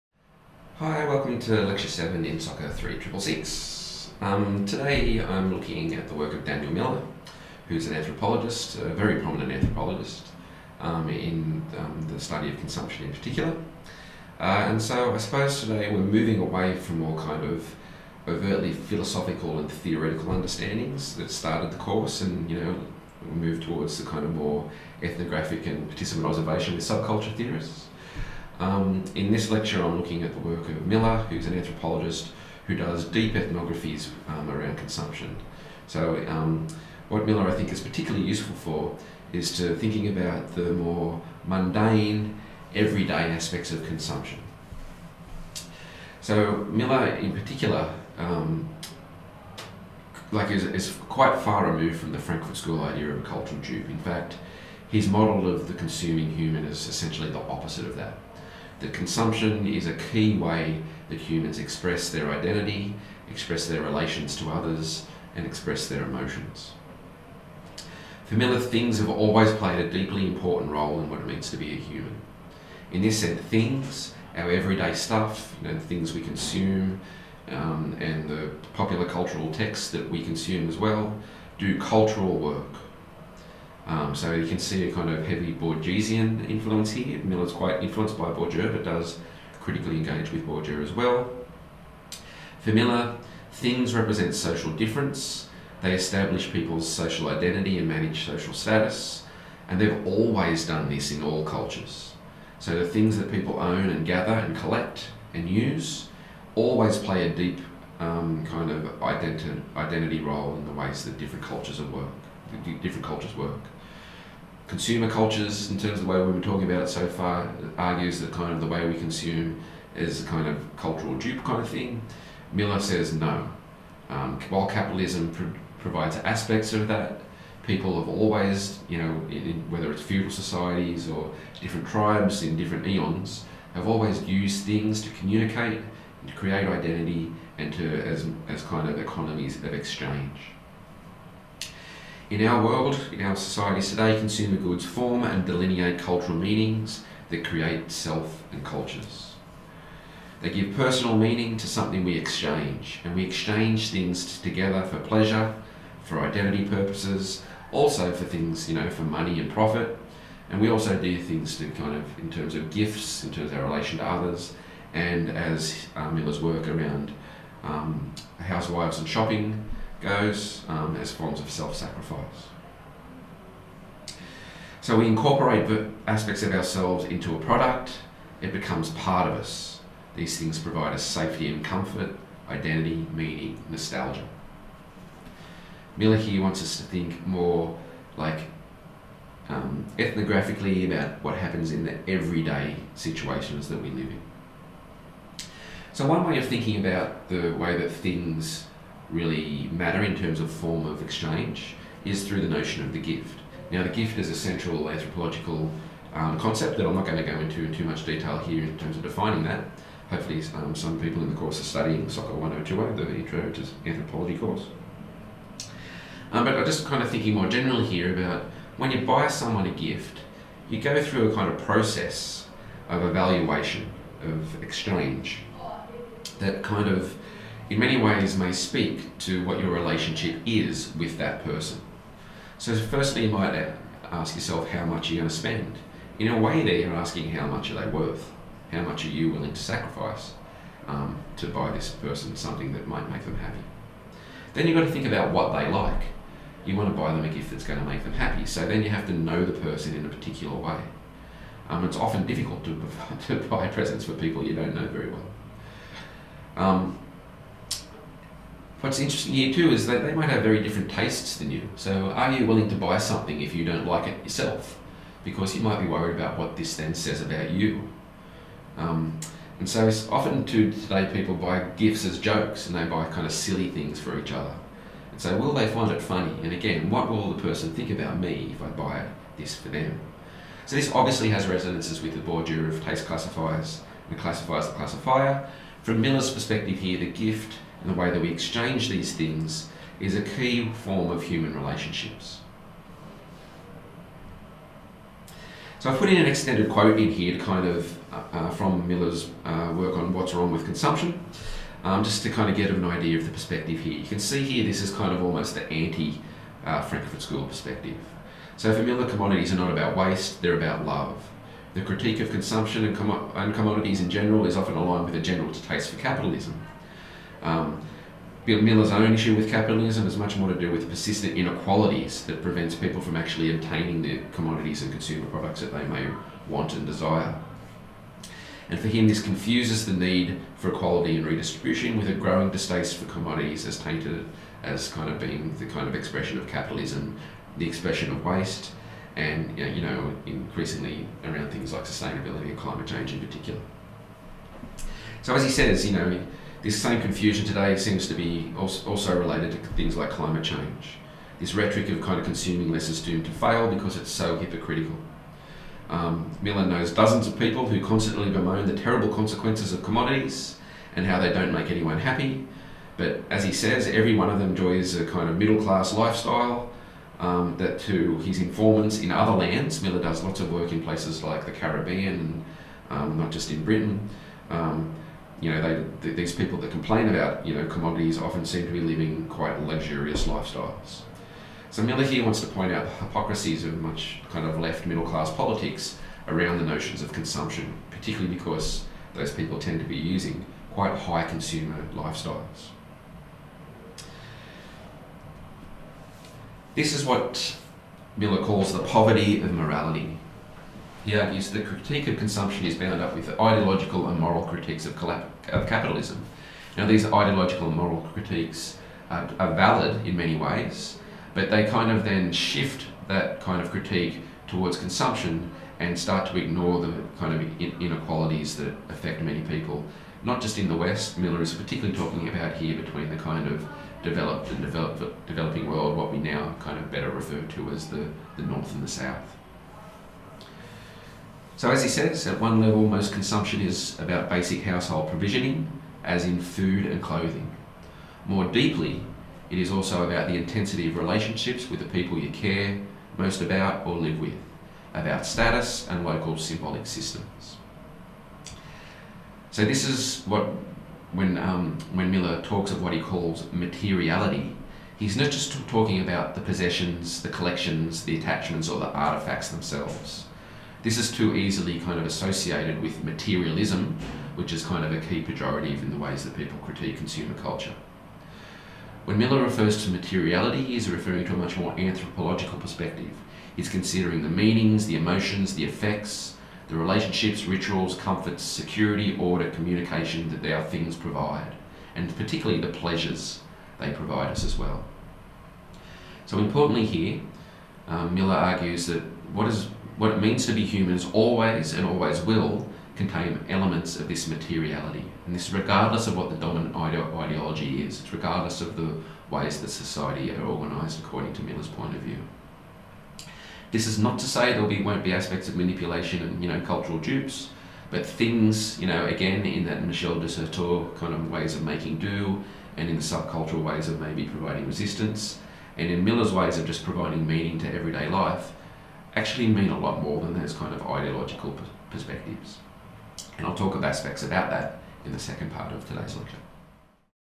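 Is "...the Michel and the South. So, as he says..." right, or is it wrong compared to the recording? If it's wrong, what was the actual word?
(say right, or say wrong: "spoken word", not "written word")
wrong: "North", not "Michel".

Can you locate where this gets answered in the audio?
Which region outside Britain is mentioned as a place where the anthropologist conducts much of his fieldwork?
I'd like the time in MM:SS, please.
06:11.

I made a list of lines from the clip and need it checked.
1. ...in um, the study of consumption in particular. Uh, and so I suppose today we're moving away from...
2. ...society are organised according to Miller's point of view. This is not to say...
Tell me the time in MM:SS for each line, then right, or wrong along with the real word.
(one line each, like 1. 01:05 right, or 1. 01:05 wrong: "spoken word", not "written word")
1. 00:11 right
2. 08:19 right.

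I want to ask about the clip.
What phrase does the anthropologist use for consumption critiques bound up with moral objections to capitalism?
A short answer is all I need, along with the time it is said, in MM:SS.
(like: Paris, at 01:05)
the poverty of morality, at 06:38.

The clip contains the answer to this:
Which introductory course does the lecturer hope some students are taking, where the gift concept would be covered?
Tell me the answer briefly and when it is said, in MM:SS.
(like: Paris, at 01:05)
Soccer 102, at 03:32.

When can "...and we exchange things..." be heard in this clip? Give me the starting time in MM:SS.
02:33.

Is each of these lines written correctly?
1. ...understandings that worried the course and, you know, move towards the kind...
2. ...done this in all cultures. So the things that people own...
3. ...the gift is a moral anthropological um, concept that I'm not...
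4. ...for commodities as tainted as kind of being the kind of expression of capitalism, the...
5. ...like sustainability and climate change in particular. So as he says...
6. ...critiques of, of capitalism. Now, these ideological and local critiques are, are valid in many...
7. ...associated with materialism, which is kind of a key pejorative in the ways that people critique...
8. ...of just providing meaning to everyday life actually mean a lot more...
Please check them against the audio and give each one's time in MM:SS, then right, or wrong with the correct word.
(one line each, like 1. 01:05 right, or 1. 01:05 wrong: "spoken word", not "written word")
1. 00:20 wrong: "started", not "worried"
2. 01:40 right
3. 03:23 wrong: "central", not "moral"
4. 05:32 right
5. 05:41 right
6. 06:44 wrong: "moral", not "local"
7. 07:42 right
8. 08:36 right.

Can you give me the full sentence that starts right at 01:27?
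Miller's quite influenced by Bourdieu, but does critically engage with Bourdieu as well.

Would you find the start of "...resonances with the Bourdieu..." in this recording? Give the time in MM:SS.
04:41.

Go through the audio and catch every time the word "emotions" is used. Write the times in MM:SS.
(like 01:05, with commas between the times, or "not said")
01:06, 07:54.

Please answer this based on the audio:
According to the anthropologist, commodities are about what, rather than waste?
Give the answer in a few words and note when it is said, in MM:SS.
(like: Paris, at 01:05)
Love, at 05:10.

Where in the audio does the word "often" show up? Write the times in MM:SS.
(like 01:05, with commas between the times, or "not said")
04:11, 04:30, 05:14, 06:18.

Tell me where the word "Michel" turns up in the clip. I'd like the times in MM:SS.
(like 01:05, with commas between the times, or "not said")
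08:29.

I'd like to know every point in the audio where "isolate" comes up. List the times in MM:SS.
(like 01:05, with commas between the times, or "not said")
not said.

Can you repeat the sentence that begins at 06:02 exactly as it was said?
But as he says, every one of them enjoys a kind of middle class lifestyle.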